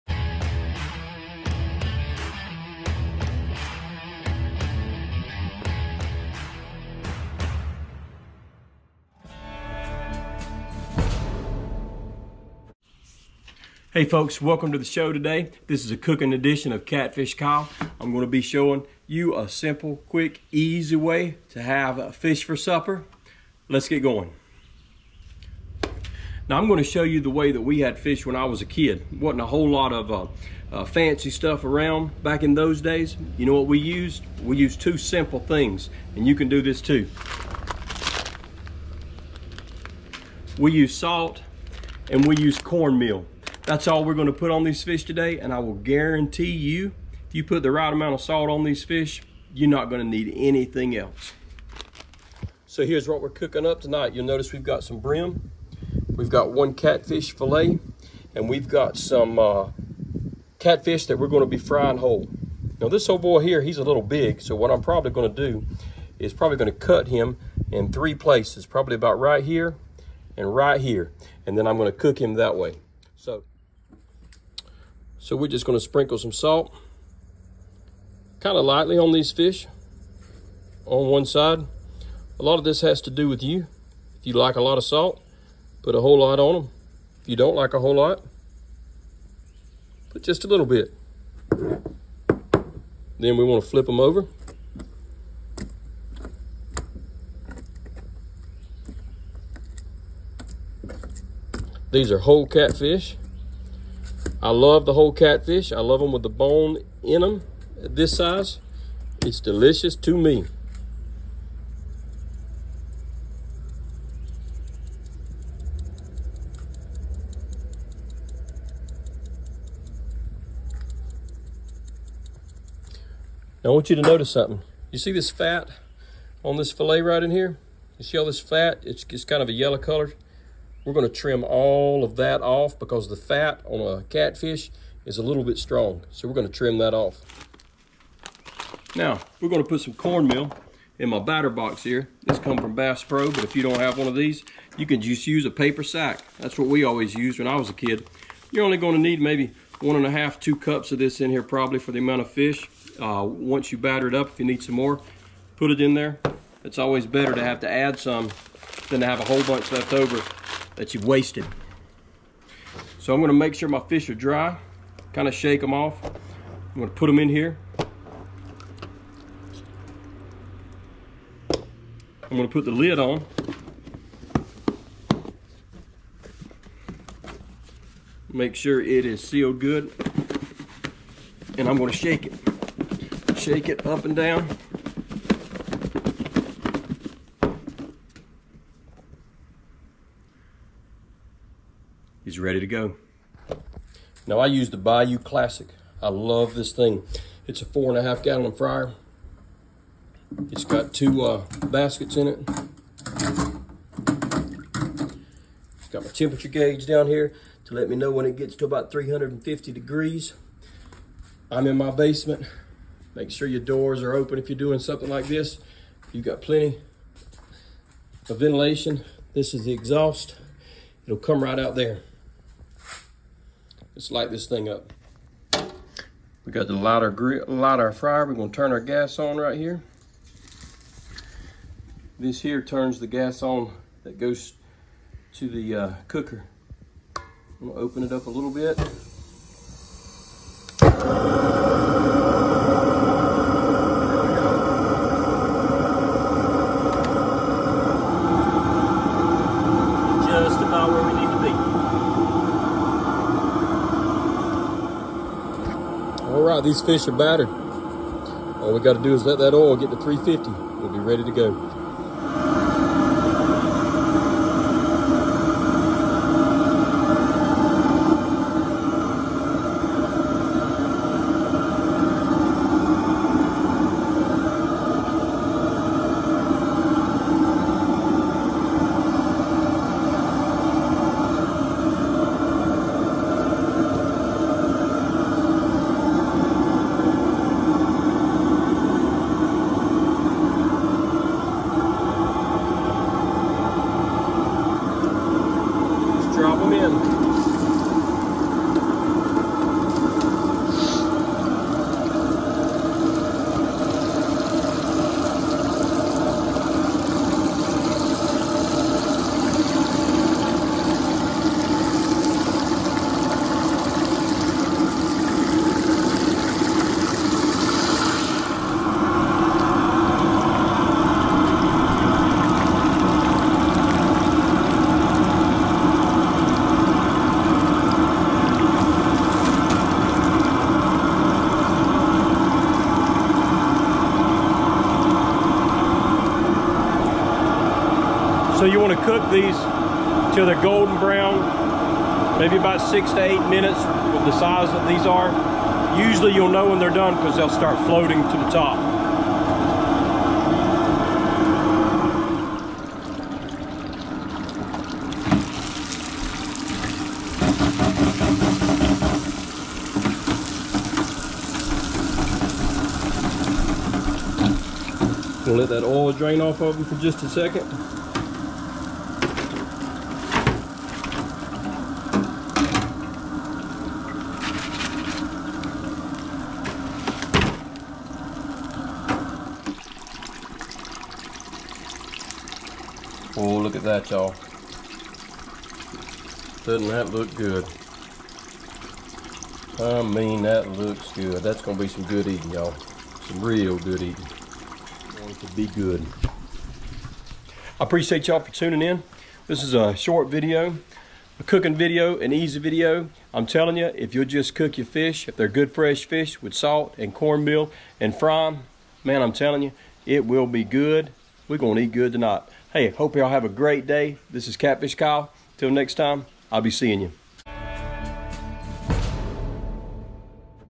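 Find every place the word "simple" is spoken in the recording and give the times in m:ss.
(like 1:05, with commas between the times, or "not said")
0:19, 0:34.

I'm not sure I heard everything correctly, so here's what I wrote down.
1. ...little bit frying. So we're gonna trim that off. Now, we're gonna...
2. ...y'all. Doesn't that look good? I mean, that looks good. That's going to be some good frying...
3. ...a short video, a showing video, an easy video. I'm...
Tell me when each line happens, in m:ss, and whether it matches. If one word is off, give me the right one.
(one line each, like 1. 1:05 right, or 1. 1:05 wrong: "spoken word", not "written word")
1. 2:15 wrong: "strong", not "frying"
2. 6:24 wrong: "eating", not "frying"
3. 6:39 wrong: "cooking", not "showing".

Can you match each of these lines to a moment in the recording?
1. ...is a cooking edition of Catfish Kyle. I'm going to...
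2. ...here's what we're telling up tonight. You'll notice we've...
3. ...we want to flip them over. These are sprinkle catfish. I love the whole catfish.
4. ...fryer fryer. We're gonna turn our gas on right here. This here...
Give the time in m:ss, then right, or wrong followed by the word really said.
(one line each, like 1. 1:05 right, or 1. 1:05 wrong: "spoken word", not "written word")
1. 0:15 right
2. 0:52 wrong: "cooking", not "telling"
3. 1:33 wrong: "whole", not "sprinkle"
4. 3:47 wrong: "lighter", not "fryer".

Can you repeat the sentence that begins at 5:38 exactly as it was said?
So you want to cook these till they're golden brown, maybe about six to eight minutes with the size that these are.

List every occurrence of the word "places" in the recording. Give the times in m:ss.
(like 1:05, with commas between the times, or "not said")
1:08.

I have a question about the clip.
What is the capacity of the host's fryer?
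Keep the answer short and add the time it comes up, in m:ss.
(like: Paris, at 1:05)
4.5 gallons, at 3:17.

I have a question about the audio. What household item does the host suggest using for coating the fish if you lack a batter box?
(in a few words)
paper sack.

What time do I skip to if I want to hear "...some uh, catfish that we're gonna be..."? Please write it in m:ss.
0:58.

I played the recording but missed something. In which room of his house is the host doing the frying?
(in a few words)
basement.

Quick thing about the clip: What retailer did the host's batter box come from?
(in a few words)
Bass Pro.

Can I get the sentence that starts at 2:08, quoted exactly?
It's, it's kind of a yellow color.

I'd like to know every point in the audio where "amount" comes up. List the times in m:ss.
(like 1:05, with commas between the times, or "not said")
0:47, 2:31.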